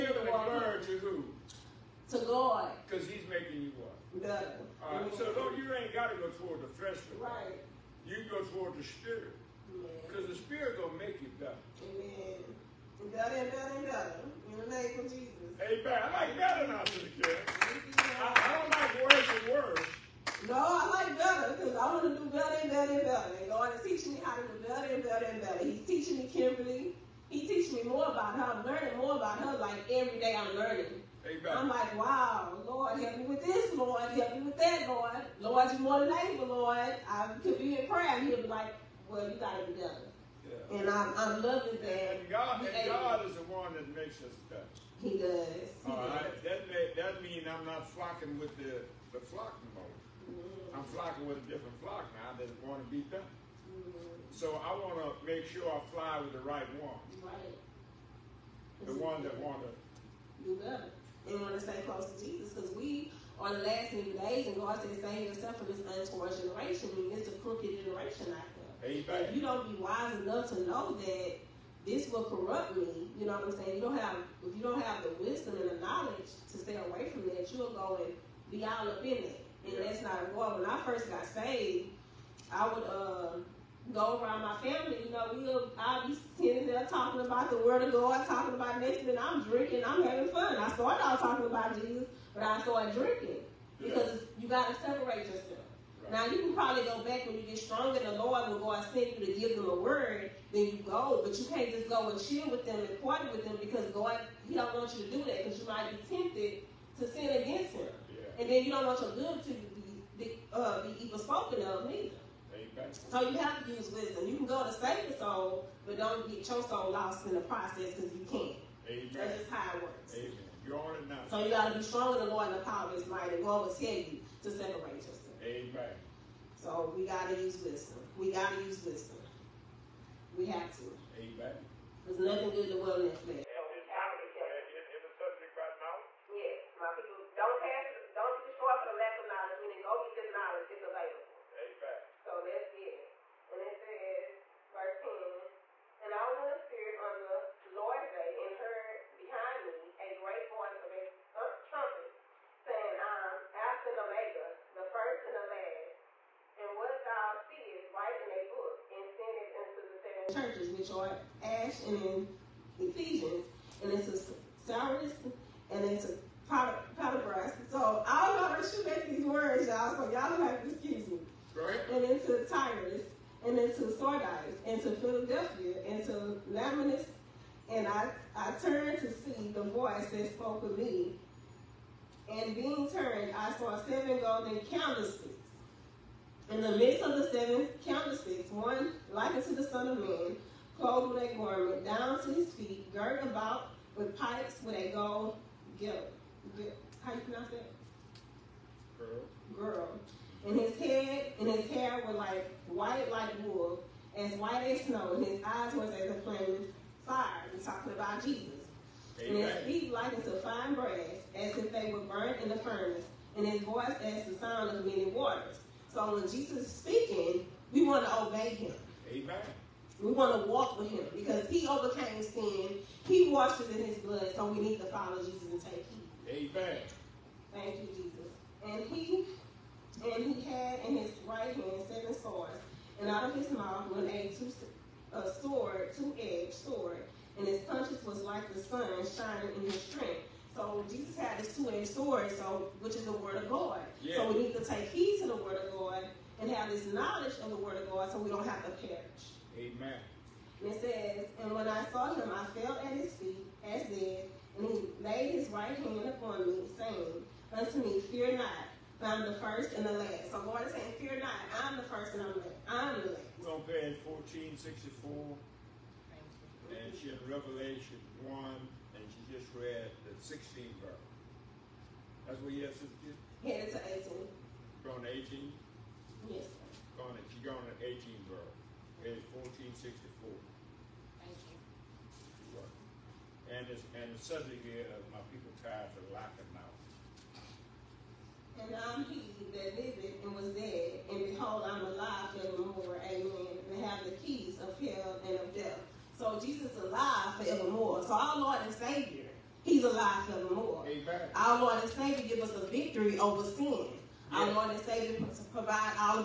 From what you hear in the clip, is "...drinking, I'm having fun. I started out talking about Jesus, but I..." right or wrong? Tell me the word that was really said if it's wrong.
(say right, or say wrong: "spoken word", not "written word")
right.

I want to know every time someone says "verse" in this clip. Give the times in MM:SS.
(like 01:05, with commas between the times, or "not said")
02:24, 04:30, 04:38.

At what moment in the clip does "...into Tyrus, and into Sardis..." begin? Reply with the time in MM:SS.
02:52.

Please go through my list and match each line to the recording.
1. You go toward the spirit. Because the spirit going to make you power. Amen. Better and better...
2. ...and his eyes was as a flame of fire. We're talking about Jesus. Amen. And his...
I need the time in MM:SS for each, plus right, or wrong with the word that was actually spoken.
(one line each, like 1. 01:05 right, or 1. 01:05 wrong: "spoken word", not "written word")
1. 00:08 wrong: "better", not "power"
2. 03:25 right.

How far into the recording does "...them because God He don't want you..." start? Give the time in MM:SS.
01:43.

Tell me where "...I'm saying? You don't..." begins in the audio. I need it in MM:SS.
01:13.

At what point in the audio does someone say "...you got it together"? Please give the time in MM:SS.
00:39.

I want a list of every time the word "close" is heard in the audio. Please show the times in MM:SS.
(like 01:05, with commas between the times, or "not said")
01:01.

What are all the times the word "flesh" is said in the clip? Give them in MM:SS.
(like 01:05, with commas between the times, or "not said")
00:06, 02:13.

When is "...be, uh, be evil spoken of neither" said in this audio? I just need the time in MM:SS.
01:50.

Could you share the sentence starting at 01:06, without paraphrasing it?
I mean, it's a crooked generation out there.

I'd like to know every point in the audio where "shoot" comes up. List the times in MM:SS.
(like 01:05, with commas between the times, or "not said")
02:48.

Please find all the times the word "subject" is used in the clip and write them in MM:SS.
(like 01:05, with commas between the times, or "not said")
02:15, 04:44.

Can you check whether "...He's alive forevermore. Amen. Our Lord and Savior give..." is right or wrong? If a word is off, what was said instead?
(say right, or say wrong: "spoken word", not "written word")
right.